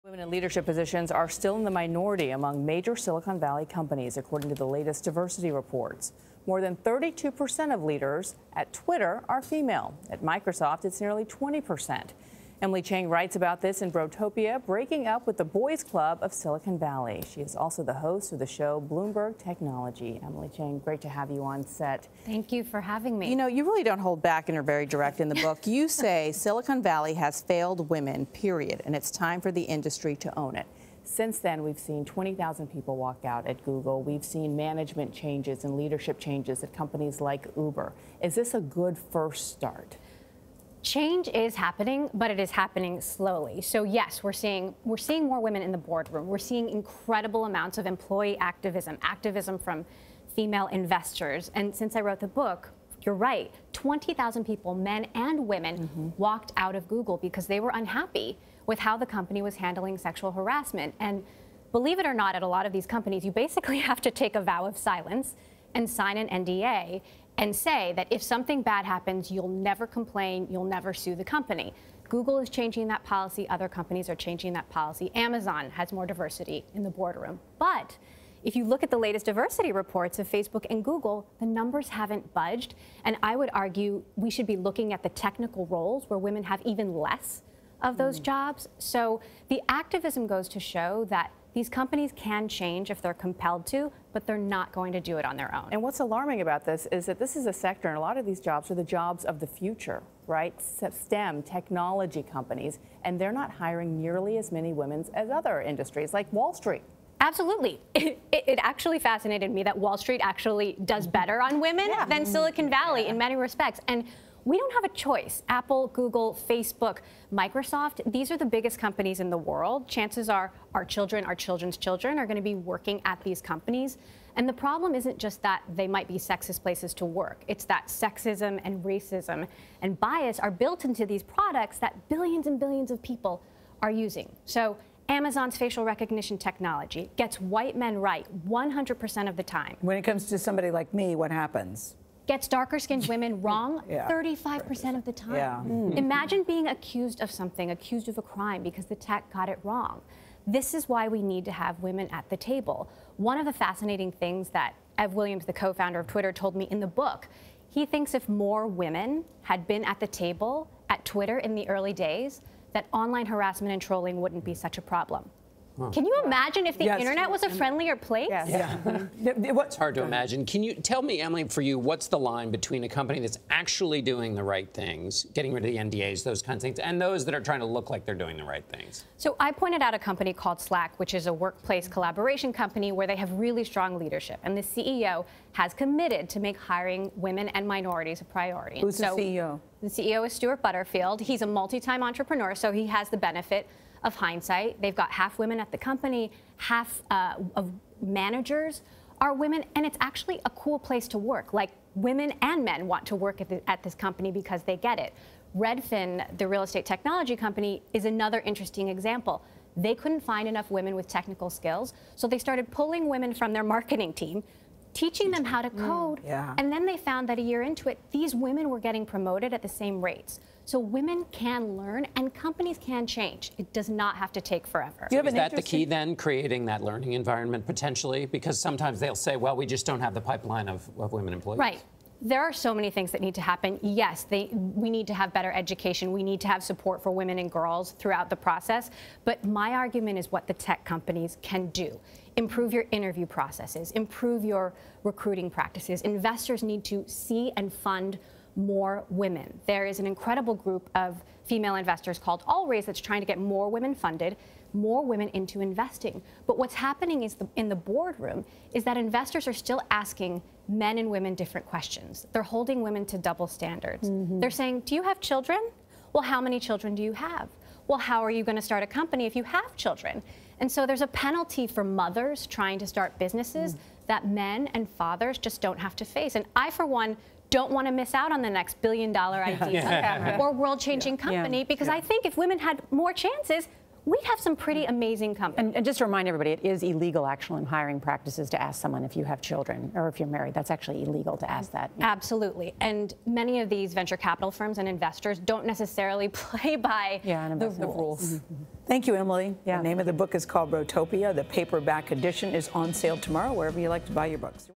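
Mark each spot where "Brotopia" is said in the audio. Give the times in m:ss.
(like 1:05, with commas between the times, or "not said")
0:13, 5:00.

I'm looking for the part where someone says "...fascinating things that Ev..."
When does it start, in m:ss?
2:33.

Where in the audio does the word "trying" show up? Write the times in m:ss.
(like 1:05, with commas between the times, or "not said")
2:57, 4:13, 4:32.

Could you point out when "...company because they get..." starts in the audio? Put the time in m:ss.
3:23.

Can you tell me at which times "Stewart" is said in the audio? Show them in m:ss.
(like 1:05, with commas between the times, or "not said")
3:10.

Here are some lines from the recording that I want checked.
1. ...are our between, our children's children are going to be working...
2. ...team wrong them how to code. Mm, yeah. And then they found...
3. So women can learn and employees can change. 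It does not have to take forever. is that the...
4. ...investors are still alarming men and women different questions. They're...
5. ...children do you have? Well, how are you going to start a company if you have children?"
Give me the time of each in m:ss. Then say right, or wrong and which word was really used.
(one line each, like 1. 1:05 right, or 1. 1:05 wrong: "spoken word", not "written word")
1. 2:00 wrong: "children", not "between"
2. 3:34 wrong: "teaching", not "wrong"
3. 3:40 wrong: "companies", not "employees"
4. 4:18 wrong: "asking", not "alarming"
5. 4:26 right.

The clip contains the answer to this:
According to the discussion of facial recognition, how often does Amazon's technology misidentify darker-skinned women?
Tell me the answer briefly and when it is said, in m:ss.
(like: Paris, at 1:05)
35%, at 2:23.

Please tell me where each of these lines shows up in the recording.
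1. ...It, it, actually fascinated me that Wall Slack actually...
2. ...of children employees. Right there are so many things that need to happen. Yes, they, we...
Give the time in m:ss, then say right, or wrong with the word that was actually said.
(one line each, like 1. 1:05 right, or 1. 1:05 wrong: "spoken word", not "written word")
1. 1:48 wrong: "Street", not "Slack"
2. 3:50 wrong: "women", not "children".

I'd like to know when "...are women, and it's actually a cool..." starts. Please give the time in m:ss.
3:19.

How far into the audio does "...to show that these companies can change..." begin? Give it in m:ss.
1:30.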